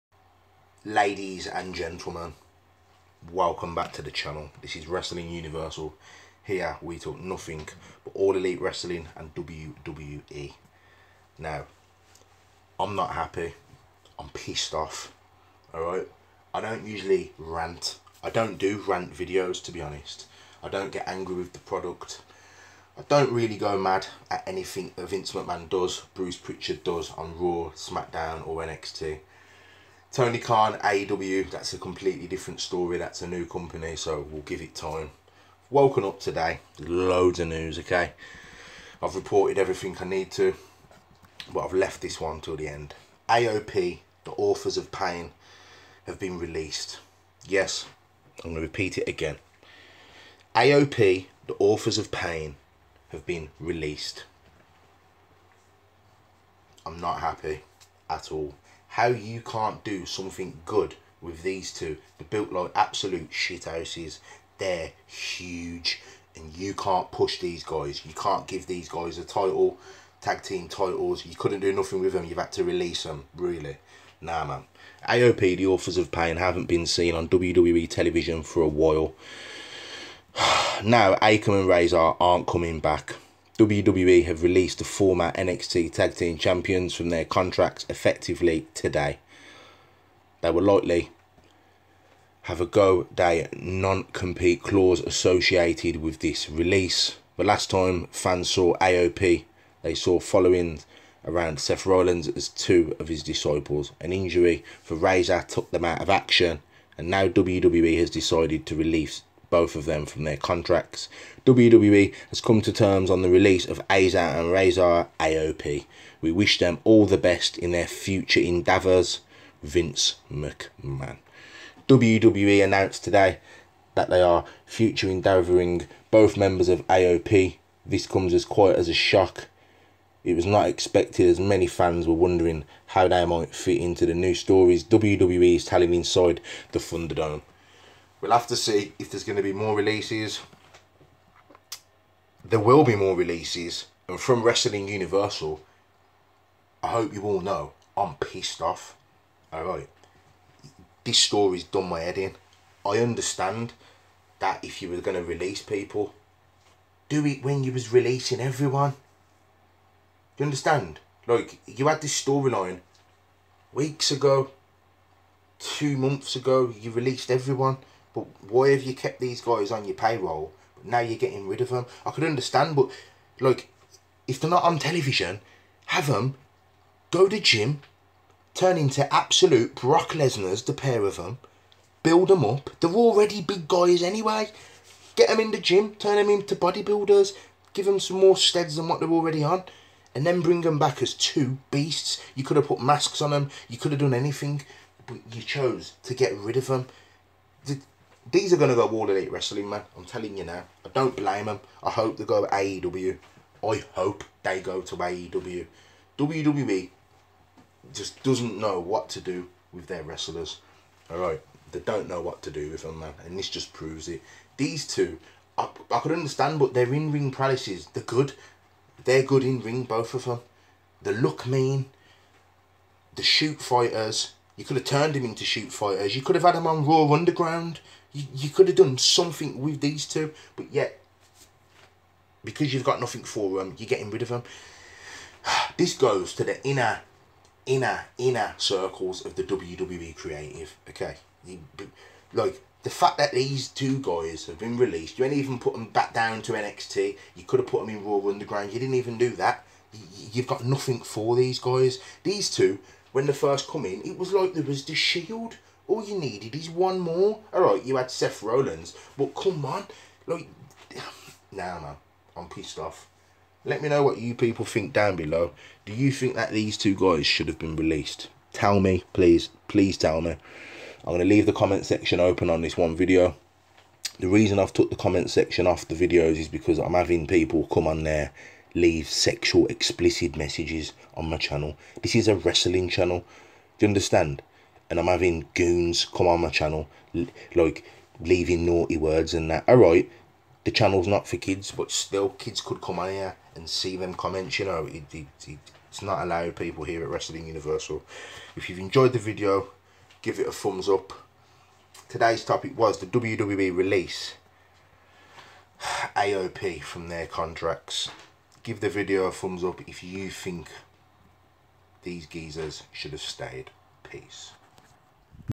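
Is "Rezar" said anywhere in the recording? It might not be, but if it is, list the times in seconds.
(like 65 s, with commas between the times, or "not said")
81 s, 104 s, 114 s.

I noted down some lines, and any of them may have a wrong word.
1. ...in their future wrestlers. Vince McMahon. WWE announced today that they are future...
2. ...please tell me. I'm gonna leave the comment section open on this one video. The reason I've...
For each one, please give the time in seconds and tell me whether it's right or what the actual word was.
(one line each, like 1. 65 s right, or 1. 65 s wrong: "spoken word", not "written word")
1. 117 s wrong: "endeavours", not "wrestlers"
2. 269 s right.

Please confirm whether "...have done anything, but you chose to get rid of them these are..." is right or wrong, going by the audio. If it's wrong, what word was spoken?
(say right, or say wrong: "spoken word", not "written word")
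right.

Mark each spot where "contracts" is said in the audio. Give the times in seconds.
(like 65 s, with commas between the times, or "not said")
87 s, 110 s, 307 s.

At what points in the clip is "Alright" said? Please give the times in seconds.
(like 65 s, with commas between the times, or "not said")
149 s, 289 s.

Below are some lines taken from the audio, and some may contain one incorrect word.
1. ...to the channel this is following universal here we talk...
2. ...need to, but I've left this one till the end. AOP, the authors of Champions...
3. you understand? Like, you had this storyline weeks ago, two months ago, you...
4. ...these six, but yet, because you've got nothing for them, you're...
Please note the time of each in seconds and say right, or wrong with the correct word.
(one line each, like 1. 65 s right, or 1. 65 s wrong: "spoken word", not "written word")
1. 3 s wrong: "wrestling", not "following"
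2. 40 s wrong: "Pain", not "Champions"
3. 160 s right
4. 229 s wrong: "two", not "six".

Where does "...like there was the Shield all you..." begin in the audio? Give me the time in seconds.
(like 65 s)
254 s.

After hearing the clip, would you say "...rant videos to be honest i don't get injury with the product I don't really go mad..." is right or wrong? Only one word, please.
wrong.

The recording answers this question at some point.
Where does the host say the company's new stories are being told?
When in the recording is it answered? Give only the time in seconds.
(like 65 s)
136 s.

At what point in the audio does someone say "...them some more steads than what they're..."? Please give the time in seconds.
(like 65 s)
187 s.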